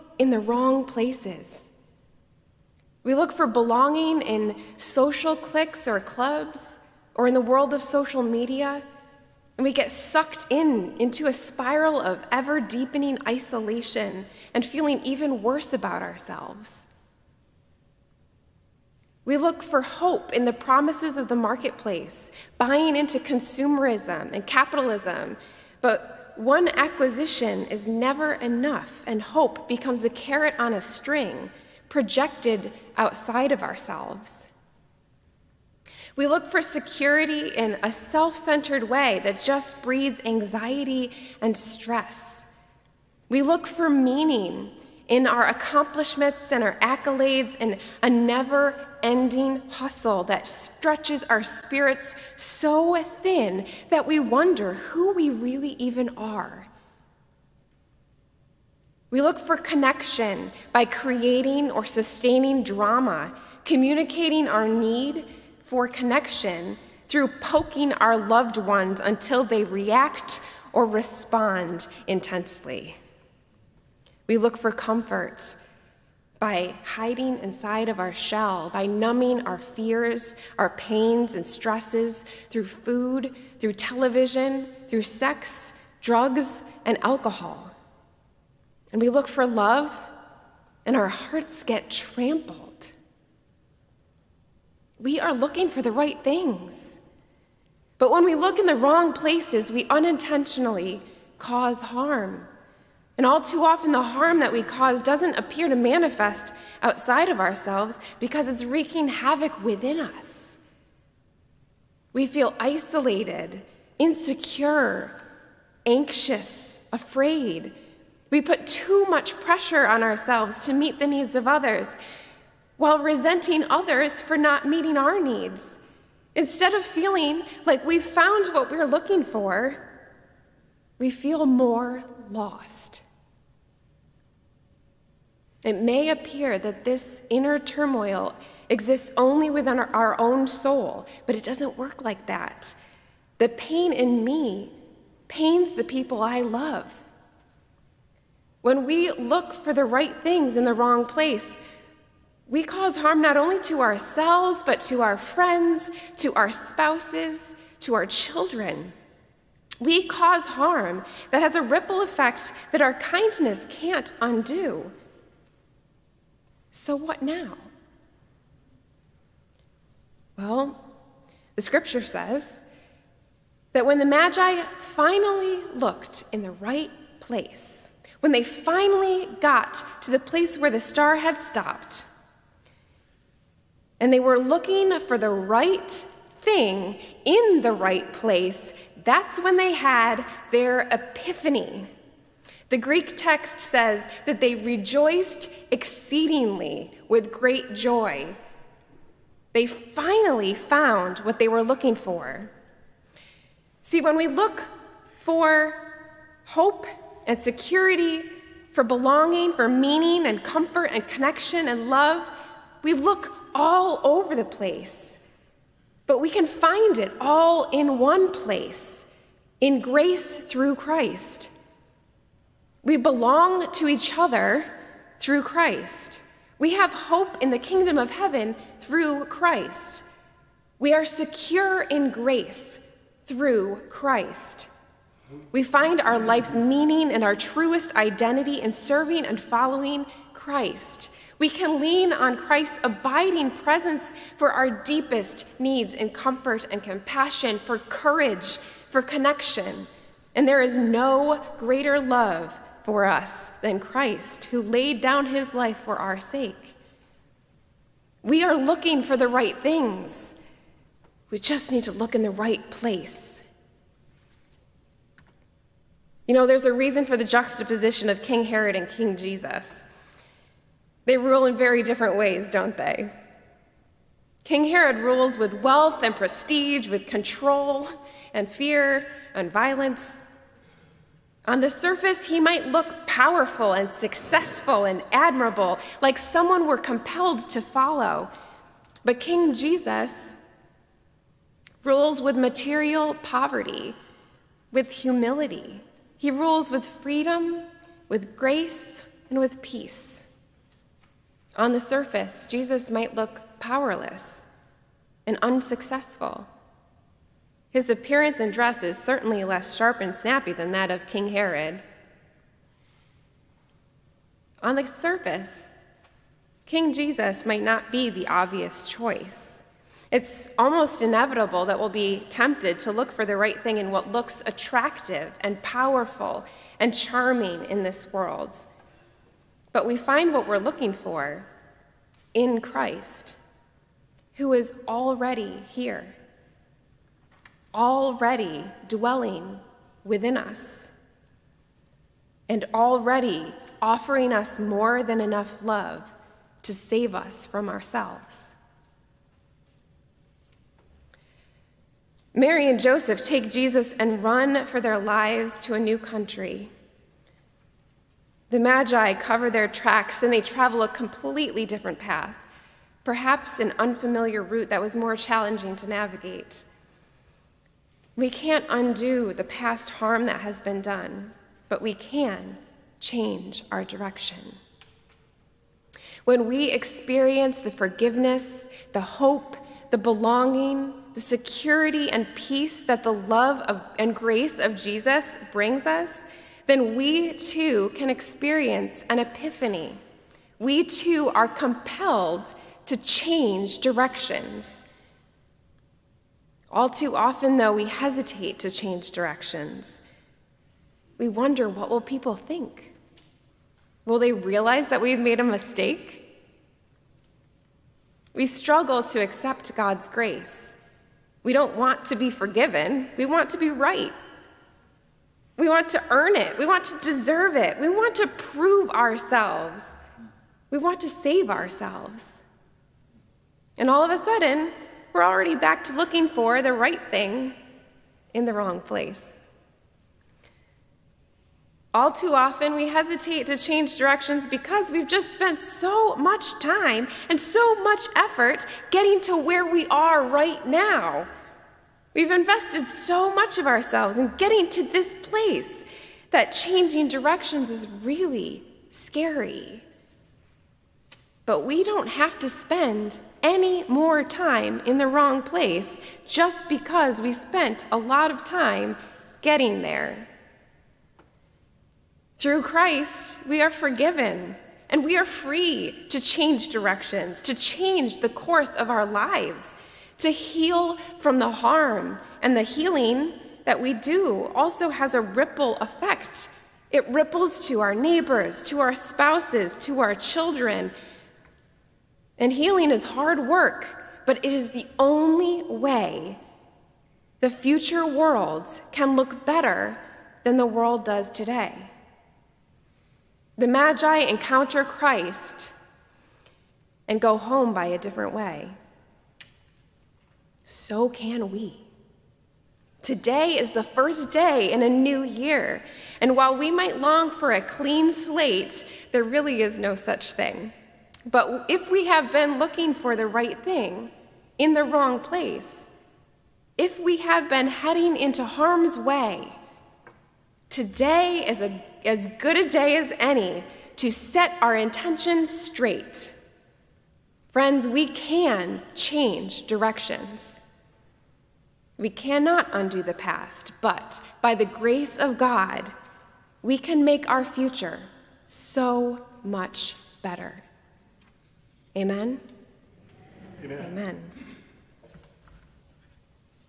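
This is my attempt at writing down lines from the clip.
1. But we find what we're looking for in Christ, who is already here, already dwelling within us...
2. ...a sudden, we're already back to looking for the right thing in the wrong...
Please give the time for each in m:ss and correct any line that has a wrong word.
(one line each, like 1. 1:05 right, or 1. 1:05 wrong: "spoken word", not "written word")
1. 5:29 right
2. 7:04 right.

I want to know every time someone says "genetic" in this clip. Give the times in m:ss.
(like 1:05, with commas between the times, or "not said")
not said.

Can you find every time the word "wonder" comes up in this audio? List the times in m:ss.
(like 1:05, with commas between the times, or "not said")
0:54, 6:41.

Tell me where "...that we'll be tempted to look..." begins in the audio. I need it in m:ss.
5:21.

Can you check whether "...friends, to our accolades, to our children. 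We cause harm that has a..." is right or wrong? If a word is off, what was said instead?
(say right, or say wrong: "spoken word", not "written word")
wrong: "spouses", not "accolades".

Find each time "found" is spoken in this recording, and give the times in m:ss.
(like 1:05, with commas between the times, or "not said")
2:08, 3:20.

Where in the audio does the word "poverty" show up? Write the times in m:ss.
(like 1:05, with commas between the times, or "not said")
4:53.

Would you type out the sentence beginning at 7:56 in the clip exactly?
It ripples to our neighbors, to our spouses, to our children.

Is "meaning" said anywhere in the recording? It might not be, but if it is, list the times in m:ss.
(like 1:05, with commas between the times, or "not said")
0:43, 3:29, 3:56.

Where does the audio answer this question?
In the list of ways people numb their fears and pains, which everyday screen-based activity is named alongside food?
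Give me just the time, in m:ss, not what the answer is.
1:23.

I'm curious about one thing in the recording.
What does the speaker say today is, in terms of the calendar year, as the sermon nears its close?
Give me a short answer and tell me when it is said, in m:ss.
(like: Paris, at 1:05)
First day in a new year, at 8:23.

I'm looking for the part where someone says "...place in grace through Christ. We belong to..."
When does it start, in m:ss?
3:38.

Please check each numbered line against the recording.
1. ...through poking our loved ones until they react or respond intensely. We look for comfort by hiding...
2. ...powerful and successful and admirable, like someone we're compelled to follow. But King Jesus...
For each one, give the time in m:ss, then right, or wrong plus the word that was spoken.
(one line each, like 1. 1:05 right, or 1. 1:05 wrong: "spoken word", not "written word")
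1. 1:07 right
2. 4:43 right.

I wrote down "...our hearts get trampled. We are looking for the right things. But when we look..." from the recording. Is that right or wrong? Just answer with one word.
right.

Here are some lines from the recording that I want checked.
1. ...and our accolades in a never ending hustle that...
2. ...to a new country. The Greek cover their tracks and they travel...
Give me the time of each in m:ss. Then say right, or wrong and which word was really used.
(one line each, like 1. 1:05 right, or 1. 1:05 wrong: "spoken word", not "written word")
1. 0:46 right
2. 5:55 wrong: "Magi", not "Greek".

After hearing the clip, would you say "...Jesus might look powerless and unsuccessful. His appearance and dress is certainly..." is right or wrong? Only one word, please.
right.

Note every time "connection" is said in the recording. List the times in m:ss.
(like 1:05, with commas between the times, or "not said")
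0:59, 1:05, 3:31, 4:09.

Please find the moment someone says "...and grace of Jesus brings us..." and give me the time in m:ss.
6:23.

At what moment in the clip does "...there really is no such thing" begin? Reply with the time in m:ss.
8:29.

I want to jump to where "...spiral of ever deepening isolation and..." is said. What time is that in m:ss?
0:11.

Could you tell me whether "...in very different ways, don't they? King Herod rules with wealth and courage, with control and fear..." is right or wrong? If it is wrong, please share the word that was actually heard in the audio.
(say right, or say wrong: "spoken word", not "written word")
wrong: "prestige", not "courage".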